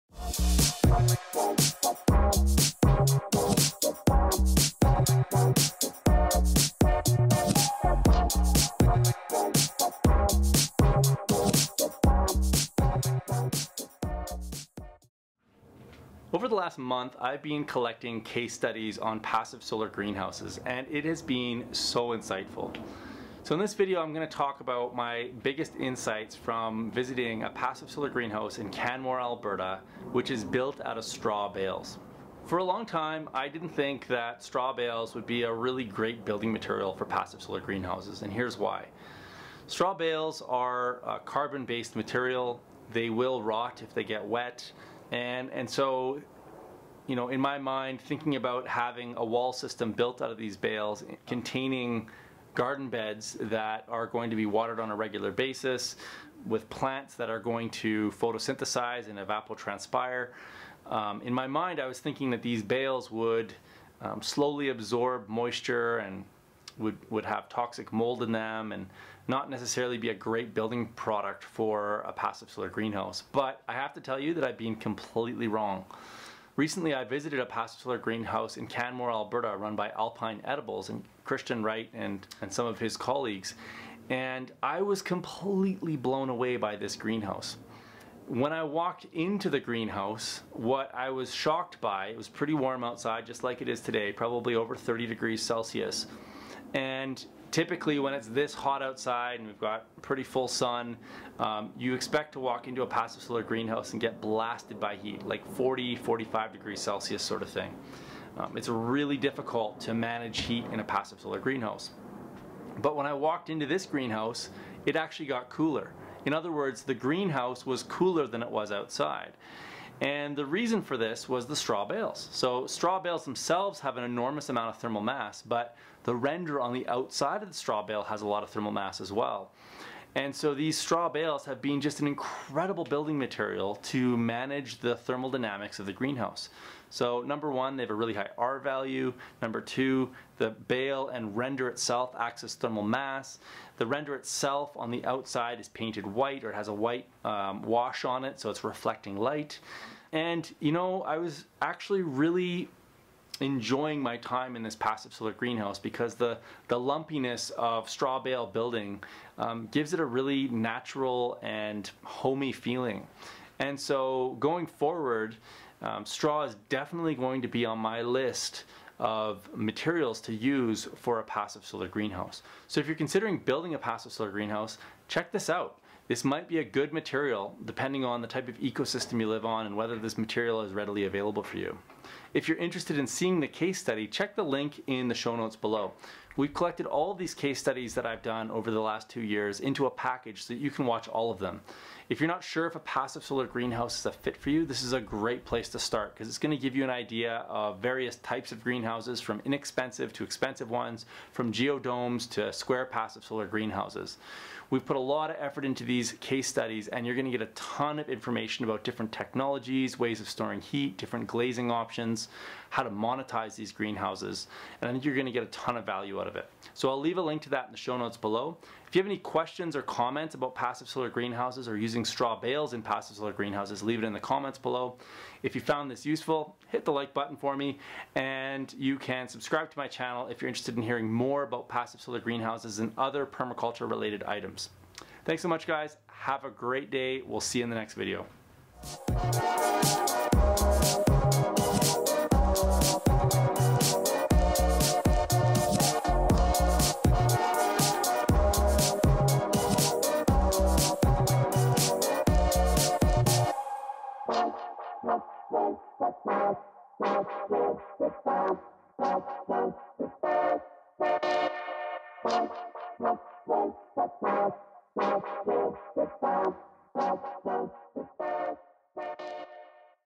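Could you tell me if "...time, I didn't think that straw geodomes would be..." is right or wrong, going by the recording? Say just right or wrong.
wrong.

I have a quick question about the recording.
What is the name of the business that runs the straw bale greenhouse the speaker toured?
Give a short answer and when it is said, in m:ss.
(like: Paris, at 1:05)
Alpine Edibles, at 1:19.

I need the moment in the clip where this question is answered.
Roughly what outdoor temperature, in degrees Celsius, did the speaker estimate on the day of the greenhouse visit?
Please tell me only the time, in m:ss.
1:34.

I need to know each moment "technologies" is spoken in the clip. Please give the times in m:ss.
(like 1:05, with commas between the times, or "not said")
3:29.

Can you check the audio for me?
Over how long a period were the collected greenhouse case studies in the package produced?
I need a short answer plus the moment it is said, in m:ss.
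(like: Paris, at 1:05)
2 years, at 3:09.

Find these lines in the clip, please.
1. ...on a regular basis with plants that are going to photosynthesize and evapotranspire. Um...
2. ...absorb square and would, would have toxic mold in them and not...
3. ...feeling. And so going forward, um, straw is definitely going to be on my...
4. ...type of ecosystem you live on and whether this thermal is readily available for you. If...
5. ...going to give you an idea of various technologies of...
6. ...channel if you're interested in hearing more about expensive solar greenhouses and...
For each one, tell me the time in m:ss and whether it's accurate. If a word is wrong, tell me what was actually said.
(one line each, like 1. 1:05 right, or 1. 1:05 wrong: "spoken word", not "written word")
1. 0:54 right
2. 1:04 wrong: "moisture", not "square"
3. 2:42 right
4. 2:58 wrong: "material", not "thermal"
5. 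3:16 wrong: "types", not "technologies"
6. 3:49 wrong: "passive", not "expensive".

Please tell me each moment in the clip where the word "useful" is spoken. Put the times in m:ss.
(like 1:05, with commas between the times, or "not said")
3:46.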